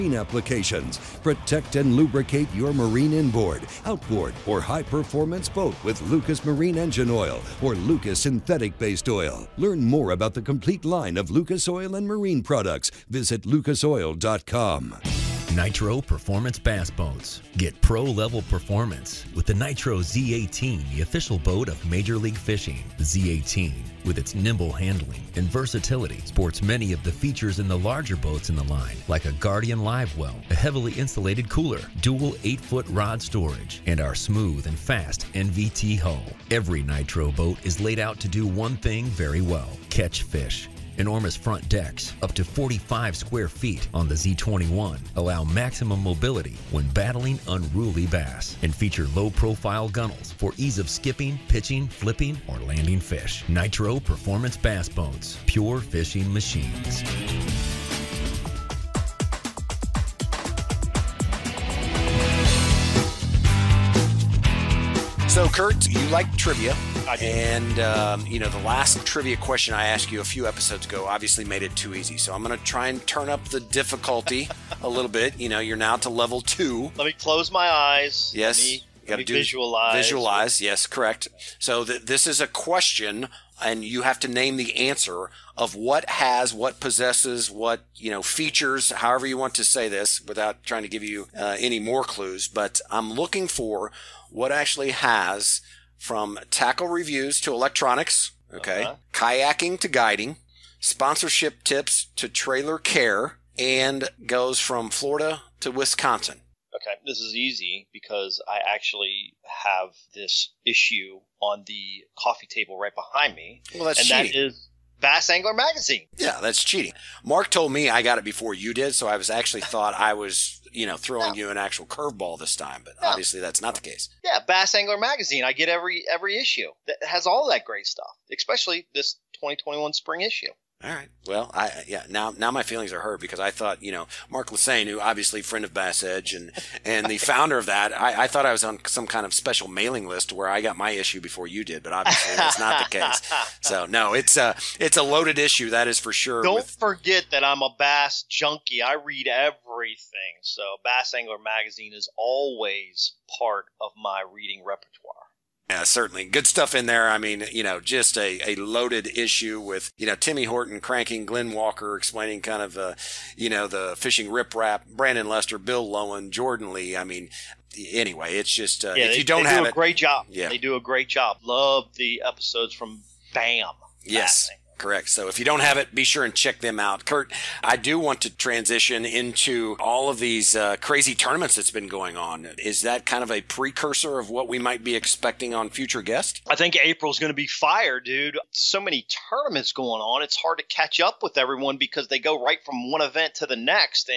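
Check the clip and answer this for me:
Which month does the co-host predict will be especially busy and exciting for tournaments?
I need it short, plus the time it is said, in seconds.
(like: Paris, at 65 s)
April, at 186 s.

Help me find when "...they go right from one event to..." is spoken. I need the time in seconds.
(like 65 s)
192 s.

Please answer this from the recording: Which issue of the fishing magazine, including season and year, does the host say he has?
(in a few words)
2021 spring issue.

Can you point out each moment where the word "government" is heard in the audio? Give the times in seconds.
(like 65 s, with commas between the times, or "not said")
not said.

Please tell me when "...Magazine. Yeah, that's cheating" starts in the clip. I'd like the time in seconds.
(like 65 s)
115 s.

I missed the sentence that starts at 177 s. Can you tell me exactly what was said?
Kurt, I do want to transition into all of these uh, crazy tournaments that's been going on.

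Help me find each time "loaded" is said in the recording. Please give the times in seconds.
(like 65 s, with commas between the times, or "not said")
145 s, 158 s.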